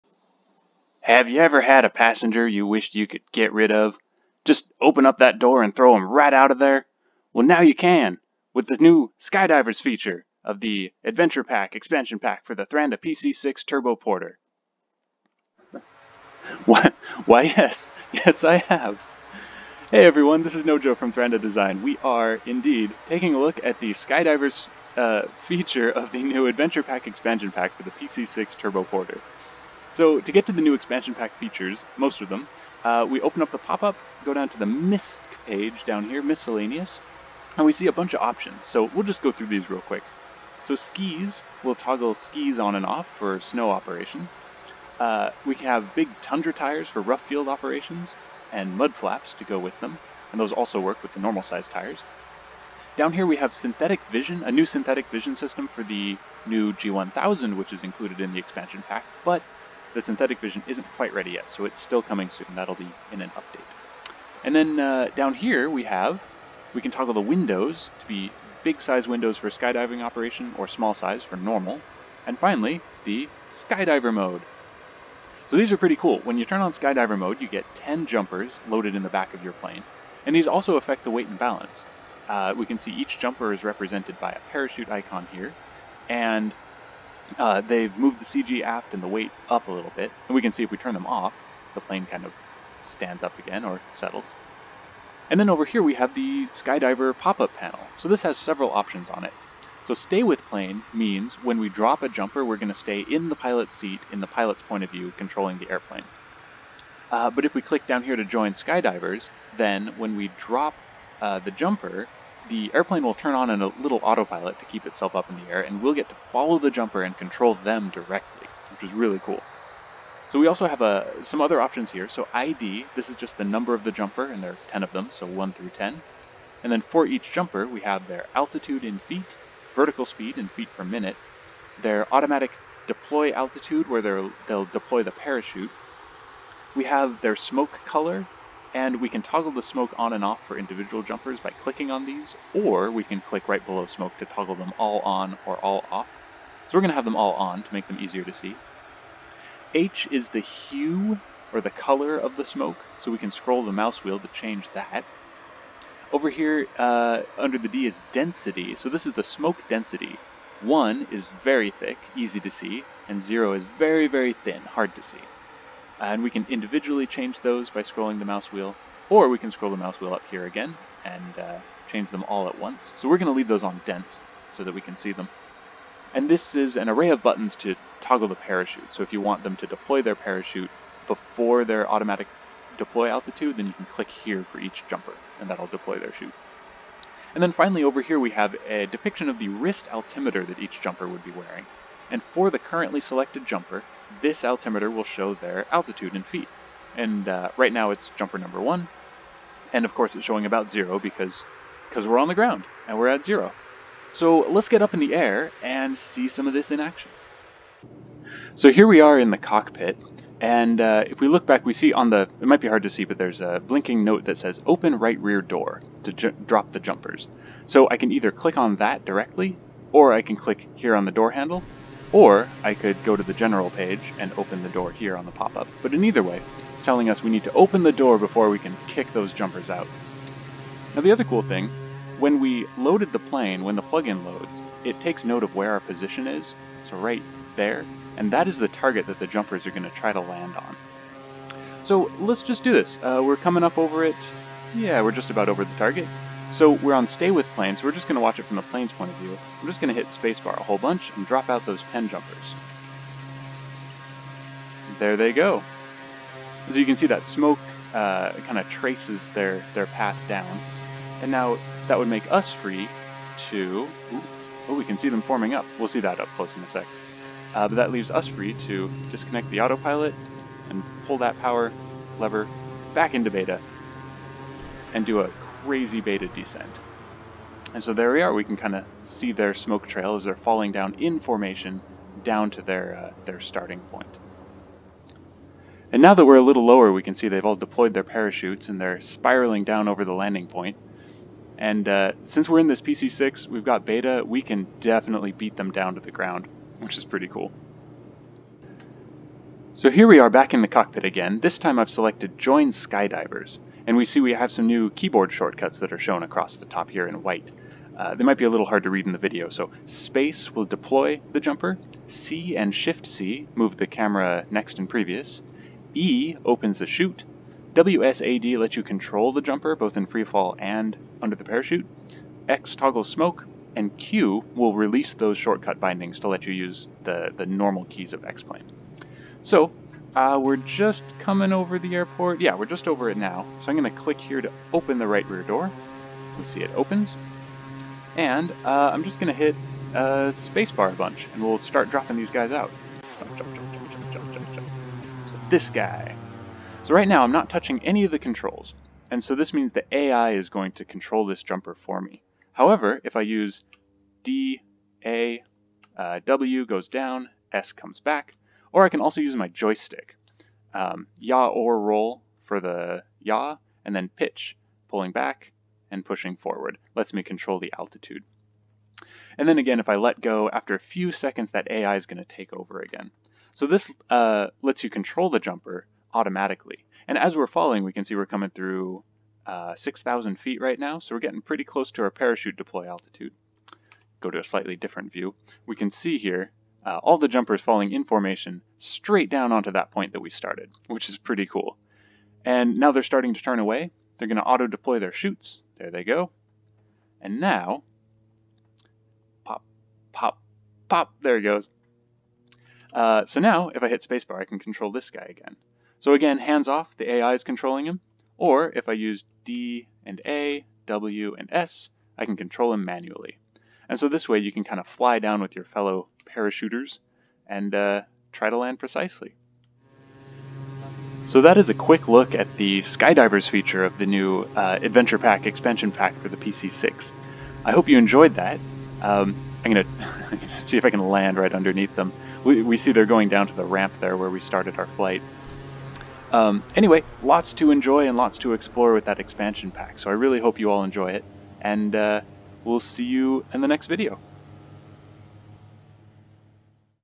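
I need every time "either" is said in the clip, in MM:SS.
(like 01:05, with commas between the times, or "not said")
03:38, 03:46.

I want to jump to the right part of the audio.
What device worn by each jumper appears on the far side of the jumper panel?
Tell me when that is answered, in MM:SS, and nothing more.
03:09.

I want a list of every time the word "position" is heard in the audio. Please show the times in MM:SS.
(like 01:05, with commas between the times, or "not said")
03:55.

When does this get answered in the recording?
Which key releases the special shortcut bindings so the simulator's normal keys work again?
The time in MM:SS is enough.
05:23.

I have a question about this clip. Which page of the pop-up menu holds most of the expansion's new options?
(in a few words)
MISC.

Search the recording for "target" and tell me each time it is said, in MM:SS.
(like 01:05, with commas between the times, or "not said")
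03:58, 04:05.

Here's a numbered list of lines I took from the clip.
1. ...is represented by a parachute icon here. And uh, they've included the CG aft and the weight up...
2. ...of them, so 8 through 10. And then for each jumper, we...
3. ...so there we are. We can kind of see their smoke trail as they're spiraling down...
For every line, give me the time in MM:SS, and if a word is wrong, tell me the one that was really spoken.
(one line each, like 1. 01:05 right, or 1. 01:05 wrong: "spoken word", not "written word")
1. 01:23 wrong: "moved", not "included"
2. 02:04 wrong: "1", not "8"
3. 04:37 wrong: "falling", not "spiraling".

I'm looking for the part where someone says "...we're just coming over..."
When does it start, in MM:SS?
05:30.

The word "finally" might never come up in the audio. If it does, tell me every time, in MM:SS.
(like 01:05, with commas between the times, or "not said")
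01:12, 03:07.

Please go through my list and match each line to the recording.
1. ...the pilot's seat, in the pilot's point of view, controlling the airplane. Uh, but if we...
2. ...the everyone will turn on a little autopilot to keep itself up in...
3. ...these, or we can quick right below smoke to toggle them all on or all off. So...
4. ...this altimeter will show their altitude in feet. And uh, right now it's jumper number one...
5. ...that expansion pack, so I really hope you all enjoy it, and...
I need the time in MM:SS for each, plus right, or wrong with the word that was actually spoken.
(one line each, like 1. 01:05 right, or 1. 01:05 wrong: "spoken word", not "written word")
1. 01:43 right
2. 01:52 wrong: "airplane", not "everyone"
3. 02:22 wrong: "click", not "quick"
4. 03:14 right
5. 07:19 right.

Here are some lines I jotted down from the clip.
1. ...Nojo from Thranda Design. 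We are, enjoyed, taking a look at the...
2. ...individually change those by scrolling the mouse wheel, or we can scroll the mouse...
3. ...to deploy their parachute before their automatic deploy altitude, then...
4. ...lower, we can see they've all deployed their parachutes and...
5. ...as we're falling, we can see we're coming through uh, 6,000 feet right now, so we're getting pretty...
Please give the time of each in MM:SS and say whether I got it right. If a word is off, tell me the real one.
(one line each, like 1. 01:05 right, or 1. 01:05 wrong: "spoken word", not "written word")
1. 00:20 wrong: "indeed", not "enjoyed"
2. 02:46 right
3. 02:59 right
4. 04:46 right
5. 06:17 right.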